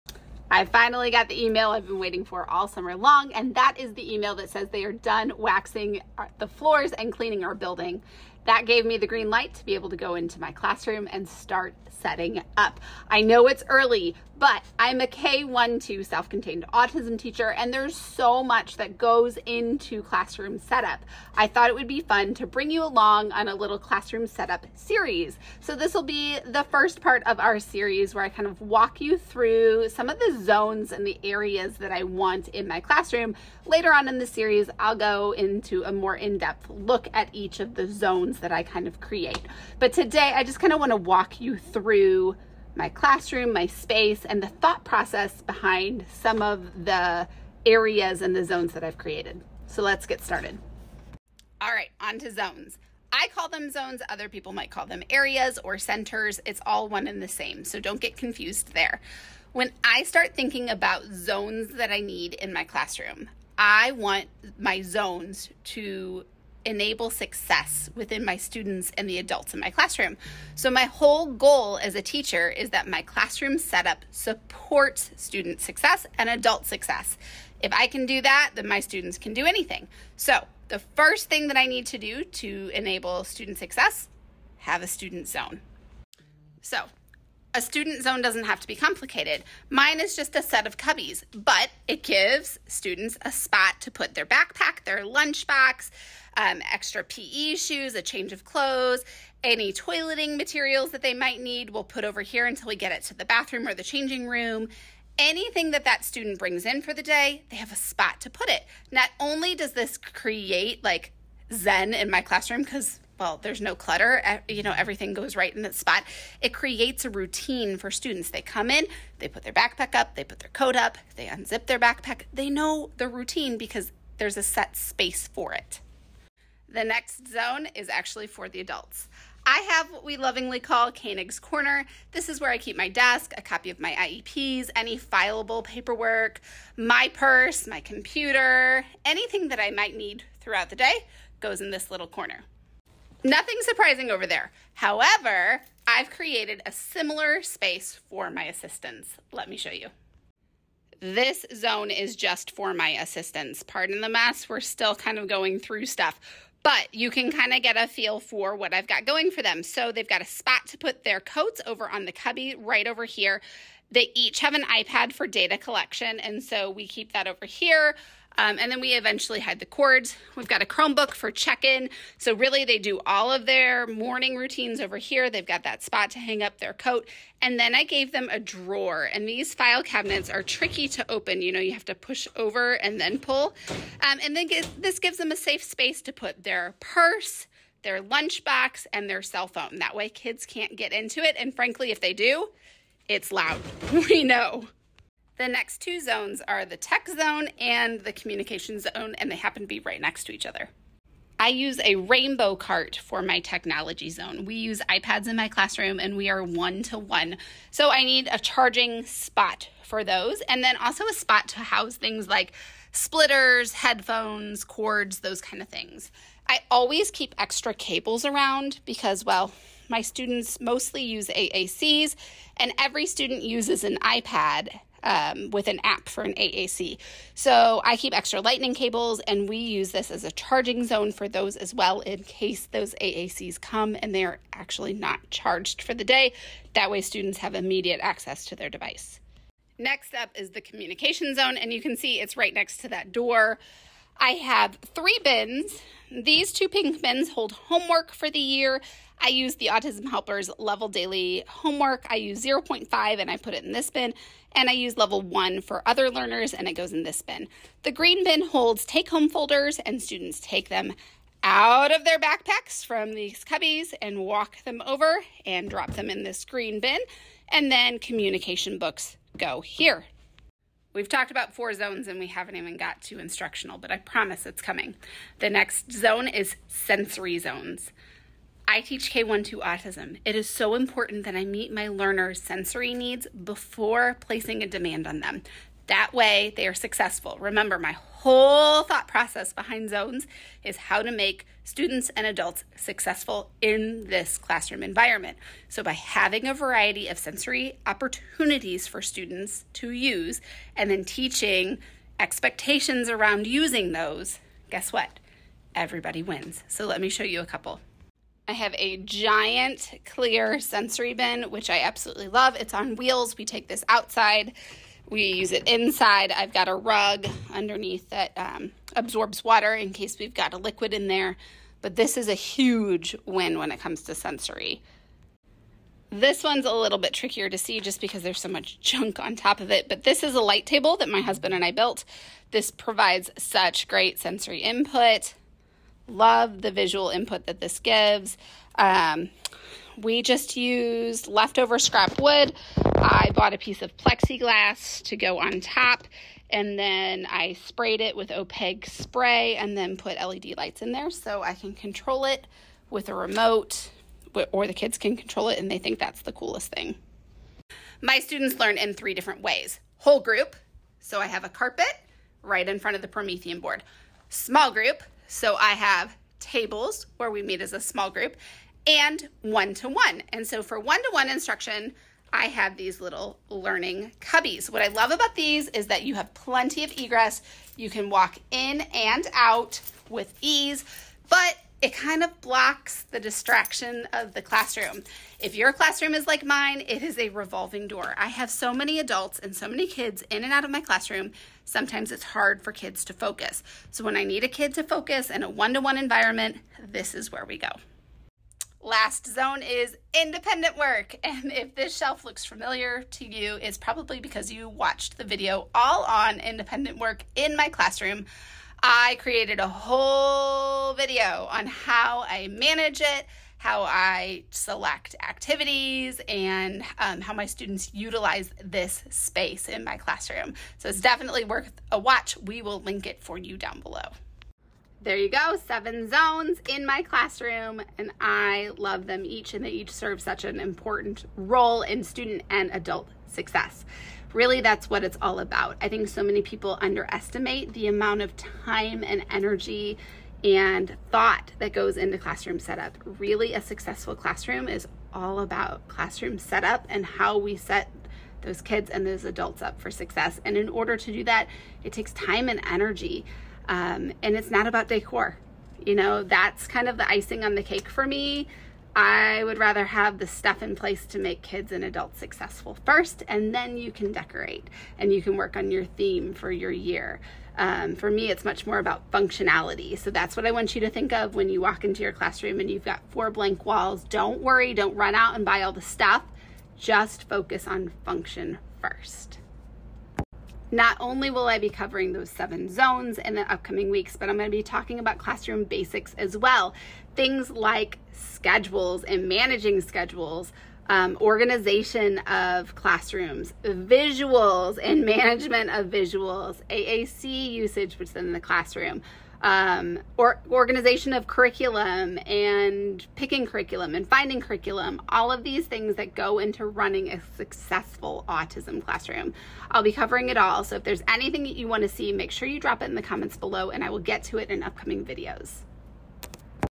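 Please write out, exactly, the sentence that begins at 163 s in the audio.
They each have an iPad for data collection, and so we keep that over here.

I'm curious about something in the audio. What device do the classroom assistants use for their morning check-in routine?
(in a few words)
Chromebook.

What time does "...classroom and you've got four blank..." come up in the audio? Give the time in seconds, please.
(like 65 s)
472 s.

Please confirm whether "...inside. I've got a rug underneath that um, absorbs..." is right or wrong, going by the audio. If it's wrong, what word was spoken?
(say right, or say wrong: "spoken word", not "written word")
right.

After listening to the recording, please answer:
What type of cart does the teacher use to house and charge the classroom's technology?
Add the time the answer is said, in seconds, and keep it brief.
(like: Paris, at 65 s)
rainbow cart, at 201 s.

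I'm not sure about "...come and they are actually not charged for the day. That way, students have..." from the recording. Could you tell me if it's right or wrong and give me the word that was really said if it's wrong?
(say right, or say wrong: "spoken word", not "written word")
right.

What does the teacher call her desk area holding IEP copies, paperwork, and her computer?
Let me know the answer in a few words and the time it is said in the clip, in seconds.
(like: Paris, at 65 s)
Koenig's Corner, at 130 s.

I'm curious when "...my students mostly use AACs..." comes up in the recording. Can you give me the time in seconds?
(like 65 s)
219 s.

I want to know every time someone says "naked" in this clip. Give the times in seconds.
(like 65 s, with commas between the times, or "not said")
not said.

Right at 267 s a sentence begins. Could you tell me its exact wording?
And then communication books go here.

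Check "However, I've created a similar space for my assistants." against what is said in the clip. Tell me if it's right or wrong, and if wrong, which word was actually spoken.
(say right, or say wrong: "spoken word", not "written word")
right.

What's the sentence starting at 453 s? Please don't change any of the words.
Um, and it's not about decor.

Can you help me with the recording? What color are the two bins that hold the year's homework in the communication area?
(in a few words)
pink.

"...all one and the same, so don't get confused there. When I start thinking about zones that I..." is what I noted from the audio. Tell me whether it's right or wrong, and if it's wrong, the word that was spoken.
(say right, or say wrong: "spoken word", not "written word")
right.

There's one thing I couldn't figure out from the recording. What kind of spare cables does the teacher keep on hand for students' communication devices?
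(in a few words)
lightning cables.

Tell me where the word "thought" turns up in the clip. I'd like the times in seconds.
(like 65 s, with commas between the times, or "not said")
21 s, 44 s, 288 s, 441 s.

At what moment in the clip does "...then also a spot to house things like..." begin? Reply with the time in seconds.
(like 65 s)
210 s.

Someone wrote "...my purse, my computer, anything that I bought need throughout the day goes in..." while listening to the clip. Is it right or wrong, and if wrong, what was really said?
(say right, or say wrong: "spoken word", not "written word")
wrong: "might", not "bought".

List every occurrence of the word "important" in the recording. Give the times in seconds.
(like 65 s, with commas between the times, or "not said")
280 s, 430 s.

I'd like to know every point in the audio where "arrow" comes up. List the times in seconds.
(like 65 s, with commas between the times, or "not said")
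not said.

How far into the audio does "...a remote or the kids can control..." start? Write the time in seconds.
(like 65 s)
353 s.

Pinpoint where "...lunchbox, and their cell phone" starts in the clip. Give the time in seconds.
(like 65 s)
188 s.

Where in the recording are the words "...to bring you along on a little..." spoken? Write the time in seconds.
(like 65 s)
22 s.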